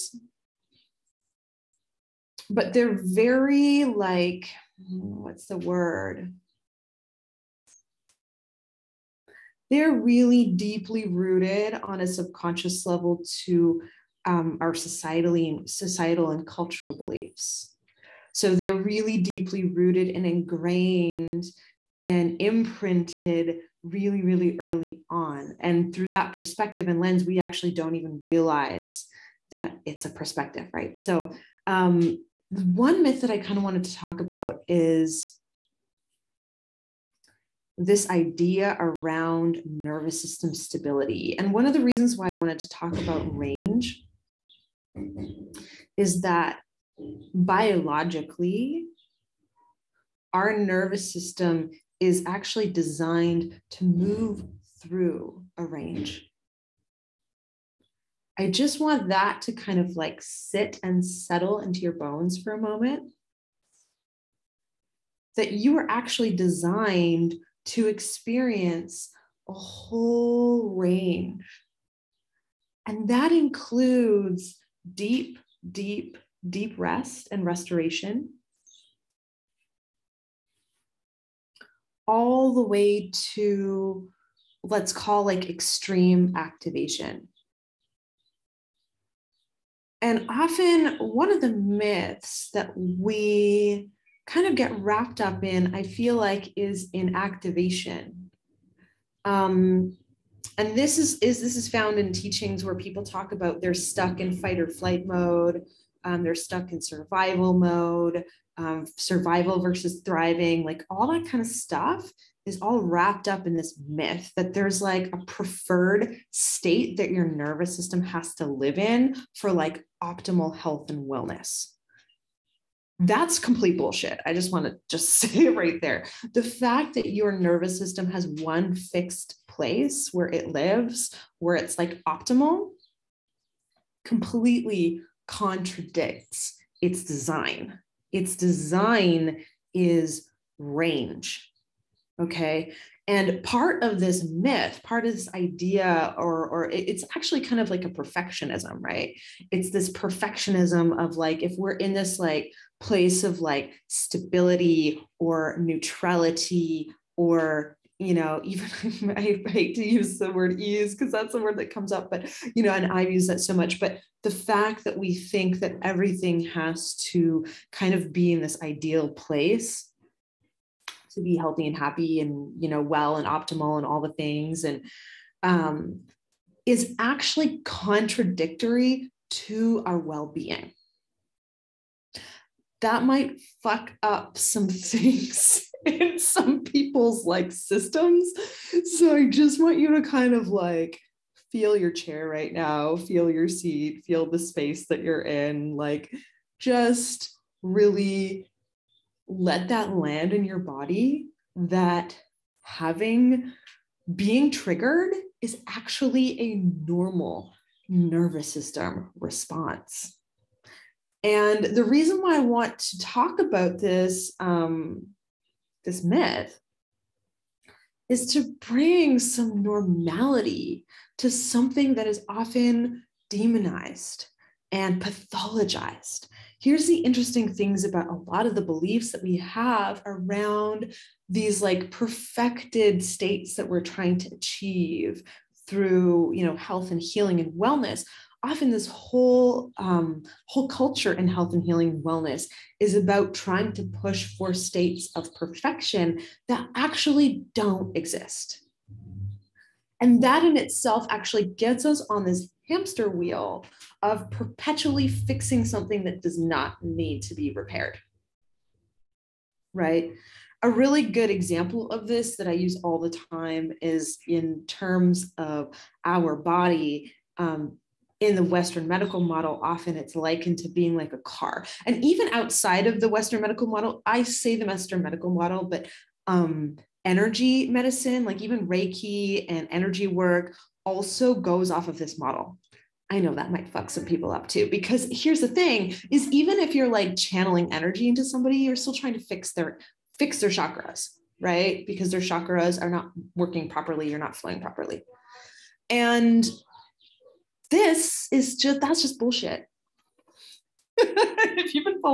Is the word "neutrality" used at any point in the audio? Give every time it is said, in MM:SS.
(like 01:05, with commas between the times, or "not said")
02:35.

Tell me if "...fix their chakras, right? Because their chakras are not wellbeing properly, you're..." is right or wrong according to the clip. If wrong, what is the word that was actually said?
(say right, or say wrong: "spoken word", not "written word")
wrong: "working", not "wellbeing".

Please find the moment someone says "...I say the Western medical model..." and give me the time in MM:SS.
04:34.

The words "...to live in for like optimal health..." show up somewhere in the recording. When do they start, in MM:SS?
01:58.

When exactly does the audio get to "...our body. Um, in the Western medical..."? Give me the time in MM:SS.
04:26.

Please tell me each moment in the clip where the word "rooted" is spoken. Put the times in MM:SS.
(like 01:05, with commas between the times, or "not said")
00:11, 00:19.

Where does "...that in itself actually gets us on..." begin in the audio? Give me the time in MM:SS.
04:10.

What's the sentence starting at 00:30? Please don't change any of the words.
So um, one myth that I kind of wanted to talk about is this idea around nervous system stability.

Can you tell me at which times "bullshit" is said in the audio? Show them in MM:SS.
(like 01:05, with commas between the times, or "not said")
02:03, 04:59.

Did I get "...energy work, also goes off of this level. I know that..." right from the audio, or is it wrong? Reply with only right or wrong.
wrong.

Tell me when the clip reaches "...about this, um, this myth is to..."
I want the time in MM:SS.
03:33.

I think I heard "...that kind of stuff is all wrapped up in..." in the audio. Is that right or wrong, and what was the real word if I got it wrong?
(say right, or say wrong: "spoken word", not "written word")
right.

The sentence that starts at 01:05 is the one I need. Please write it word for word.
That you are actually designed to experience a whole range.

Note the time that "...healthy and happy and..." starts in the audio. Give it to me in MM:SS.
02:51.